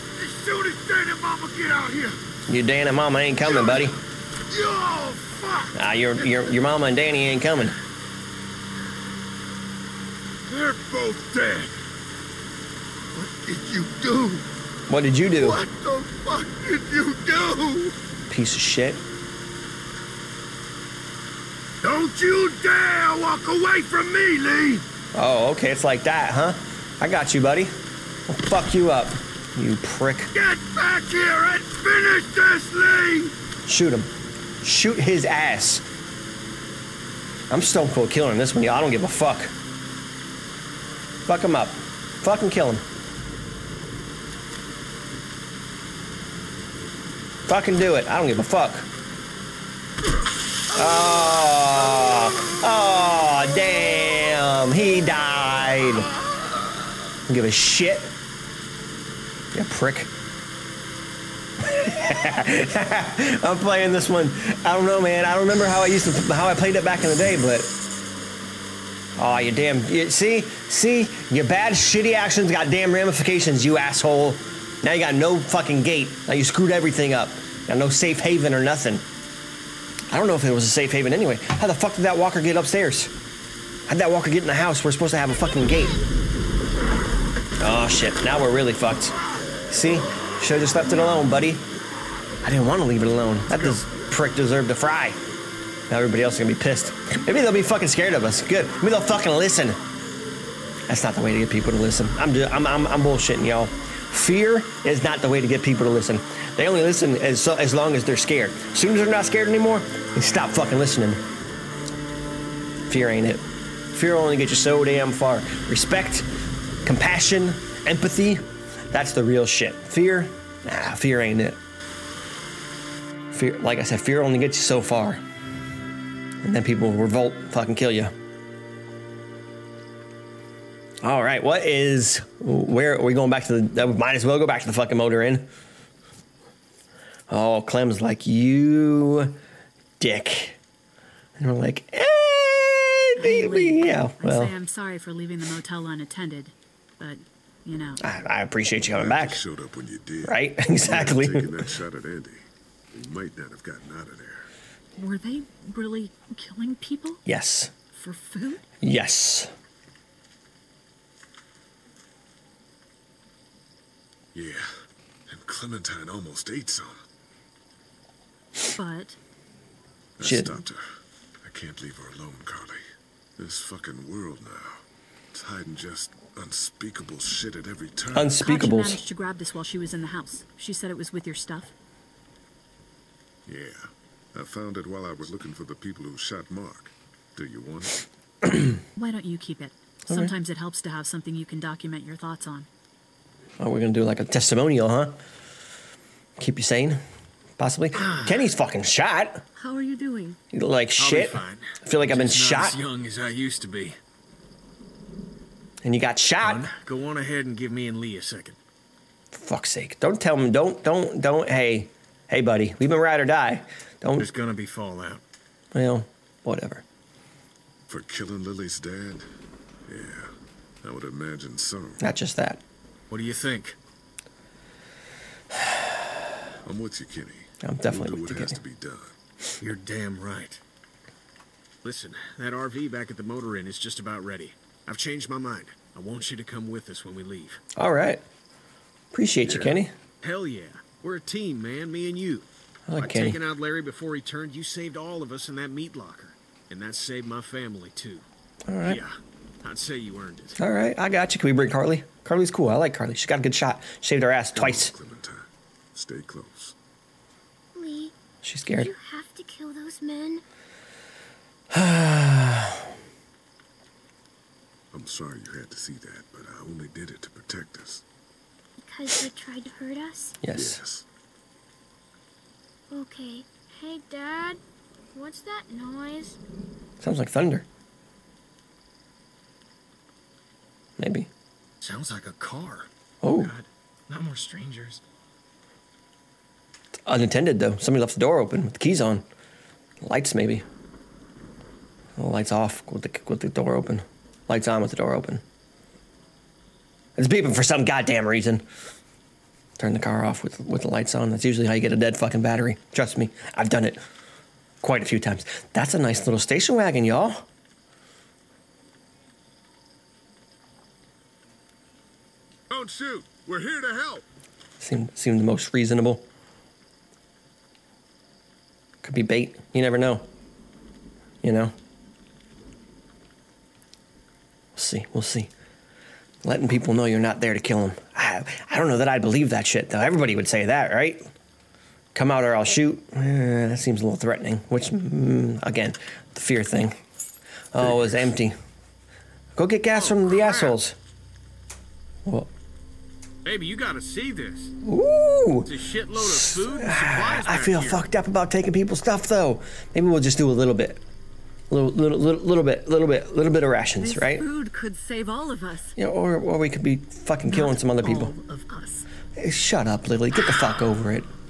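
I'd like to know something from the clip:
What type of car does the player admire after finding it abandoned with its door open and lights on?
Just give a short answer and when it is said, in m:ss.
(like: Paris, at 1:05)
Station wagon, at 5:06.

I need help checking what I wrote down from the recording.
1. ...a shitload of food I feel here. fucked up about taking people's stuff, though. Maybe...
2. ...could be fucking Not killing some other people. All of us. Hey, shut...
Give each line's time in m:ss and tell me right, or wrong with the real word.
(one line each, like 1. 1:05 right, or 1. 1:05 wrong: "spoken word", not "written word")
1. 5:45 right
2. 5:56 right.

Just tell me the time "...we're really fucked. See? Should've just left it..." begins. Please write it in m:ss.
1:28.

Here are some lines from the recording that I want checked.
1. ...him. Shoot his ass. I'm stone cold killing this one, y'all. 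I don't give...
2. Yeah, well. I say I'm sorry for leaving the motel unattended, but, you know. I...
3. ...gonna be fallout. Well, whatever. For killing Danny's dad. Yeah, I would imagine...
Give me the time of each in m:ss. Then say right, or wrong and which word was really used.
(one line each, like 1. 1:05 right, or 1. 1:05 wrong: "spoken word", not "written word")
1. 0:33 right
2. 2:23 right
3. 3:34 wrong: "Lilly", not "Danny".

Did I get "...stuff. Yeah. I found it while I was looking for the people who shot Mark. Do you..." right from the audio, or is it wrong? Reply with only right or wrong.
right.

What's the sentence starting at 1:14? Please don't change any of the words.
Now you got no fucking gate.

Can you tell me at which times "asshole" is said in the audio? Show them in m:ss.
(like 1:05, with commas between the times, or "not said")
1:13, 5:40.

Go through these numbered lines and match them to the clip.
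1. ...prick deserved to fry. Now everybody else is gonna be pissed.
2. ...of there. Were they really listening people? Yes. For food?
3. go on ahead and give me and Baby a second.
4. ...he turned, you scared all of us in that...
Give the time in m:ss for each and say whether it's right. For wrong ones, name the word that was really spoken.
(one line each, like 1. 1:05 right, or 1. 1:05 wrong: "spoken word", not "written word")
1. 1:34 right
2. 2:34 wrong: "killing", not "listening"
3. 3:26 wrong: "Lee", not "Baby"
4. 4:04 wrong: "saved", not "scared".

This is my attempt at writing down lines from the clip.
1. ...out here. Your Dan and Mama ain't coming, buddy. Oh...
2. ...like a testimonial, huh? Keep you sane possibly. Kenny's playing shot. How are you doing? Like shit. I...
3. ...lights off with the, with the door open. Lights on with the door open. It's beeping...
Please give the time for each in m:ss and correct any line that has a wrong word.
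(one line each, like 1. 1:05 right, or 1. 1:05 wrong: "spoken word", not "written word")
1. 0:01 right
2. 3:14 wrong: "fucking", not "playing"
3. 4:52 right.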